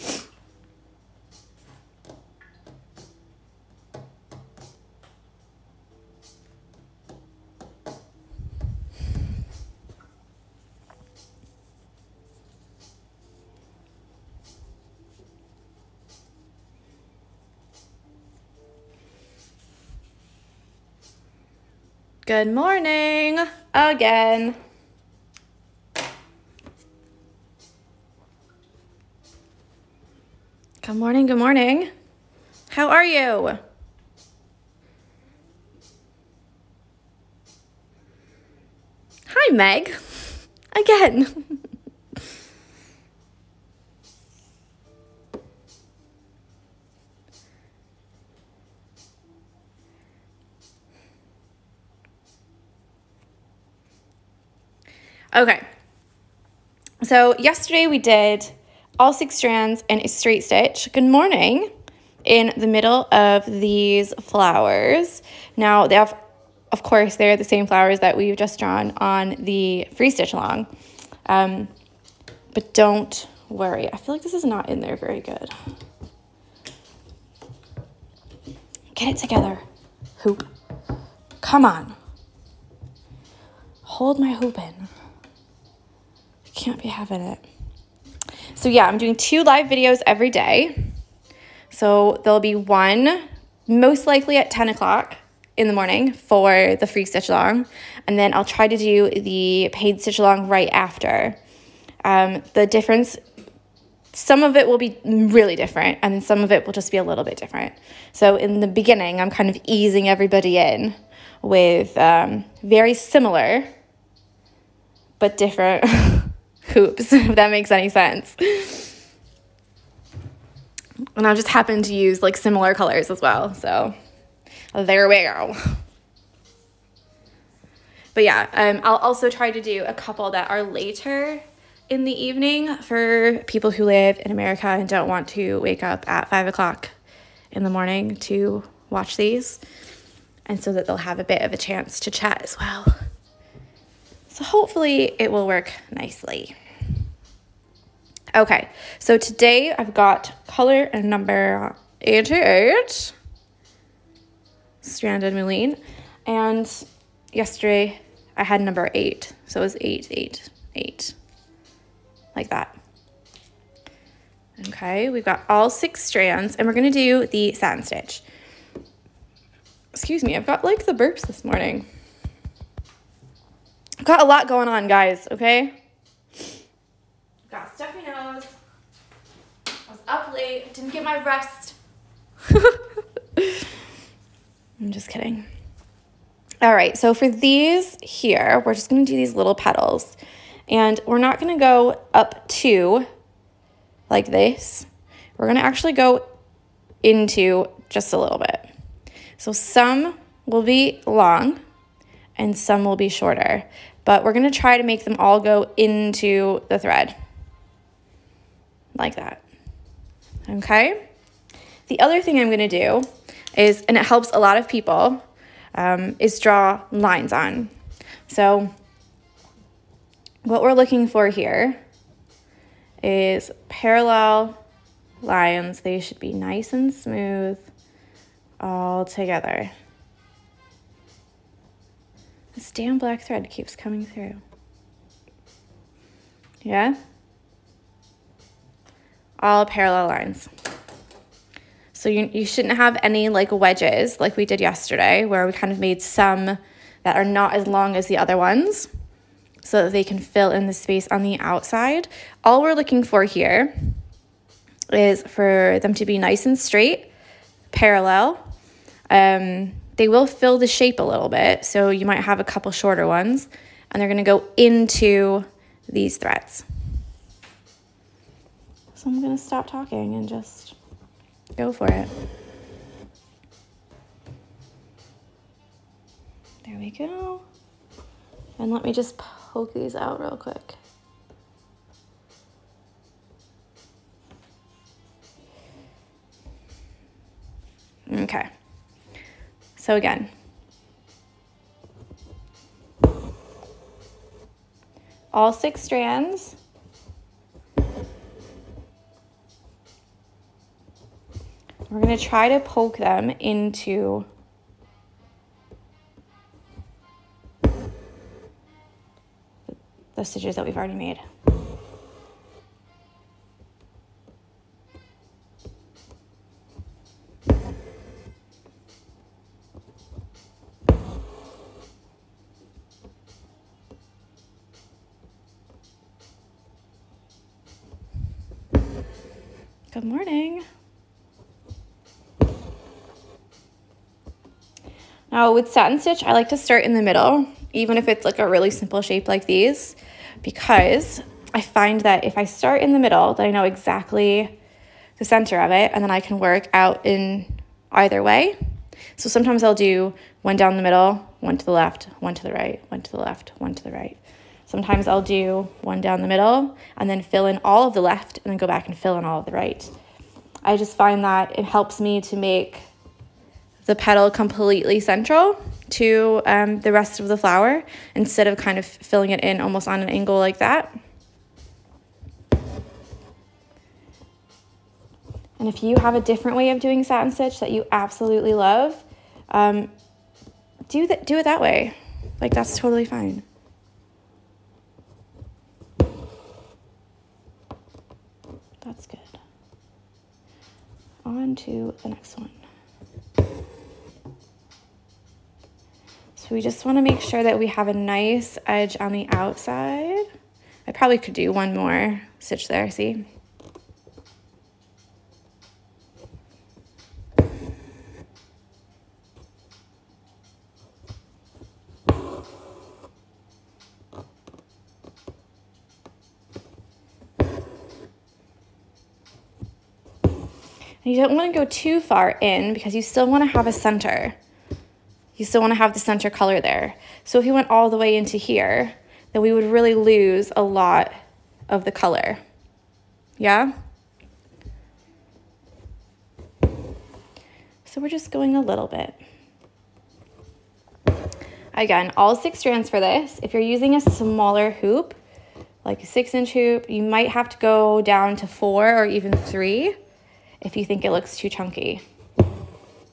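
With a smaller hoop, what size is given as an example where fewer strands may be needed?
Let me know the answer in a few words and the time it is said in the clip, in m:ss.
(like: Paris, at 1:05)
6 inch, at 7:26.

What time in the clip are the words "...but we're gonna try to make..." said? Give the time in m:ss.
3:24.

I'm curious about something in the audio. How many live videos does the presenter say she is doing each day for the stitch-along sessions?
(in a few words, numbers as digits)
2.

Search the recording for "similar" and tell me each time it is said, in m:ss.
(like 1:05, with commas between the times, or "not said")
1:52, 2:02.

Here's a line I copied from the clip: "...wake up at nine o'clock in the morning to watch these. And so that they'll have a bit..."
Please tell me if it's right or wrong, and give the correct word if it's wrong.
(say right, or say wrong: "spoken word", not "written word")
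wrong: "five", not "nine".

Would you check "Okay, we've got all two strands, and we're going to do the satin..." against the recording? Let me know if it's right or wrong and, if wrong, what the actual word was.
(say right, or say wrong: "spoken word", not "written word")
wrong: "six", not "two".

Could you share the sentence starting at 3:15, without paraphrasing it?
We're gonna actually go into just a little bit.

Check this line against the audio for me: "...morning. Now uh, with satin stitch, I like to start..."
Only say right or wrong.
right.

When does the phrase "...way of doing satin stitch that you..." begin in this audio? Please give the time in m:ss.
6:16.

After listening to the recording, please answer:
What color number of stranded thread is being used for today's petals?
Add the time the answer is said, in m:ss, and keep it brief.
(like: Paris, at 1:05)
88, at 2:31.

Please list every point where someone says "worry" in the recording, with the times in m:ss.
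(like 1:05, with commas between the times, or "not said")
1:13.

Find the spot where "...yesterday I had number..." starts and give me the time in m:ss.
2:37.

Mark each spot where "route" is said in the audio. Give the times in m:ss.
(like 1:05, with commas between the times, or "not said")
not said.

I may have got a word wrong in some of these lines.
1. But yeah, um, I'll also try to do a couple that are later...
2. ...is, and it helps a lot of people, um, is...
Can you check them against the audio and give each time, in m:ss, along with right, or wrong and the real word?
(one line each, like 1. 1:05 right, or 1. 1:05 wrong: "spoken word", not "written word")
1. 2:08 right
2. 3:33 right.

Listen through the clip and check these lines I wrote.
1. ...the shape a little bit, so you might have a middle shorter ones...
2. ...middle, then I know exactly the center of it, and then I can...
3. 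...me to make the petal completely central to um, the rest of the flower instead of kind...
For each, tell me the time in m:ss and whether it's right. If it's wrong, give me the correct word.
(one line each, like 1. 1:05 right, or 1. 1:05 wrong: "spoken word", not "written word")
1. 4:20 wrong: "couple", not "middle"
2. 5:42 right
3. 6:01 right.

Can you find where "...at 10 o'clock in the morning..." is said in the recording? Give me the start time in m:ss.
1:34.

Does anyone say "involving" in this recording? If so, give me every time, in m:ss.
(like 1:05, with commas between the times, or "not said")
not said.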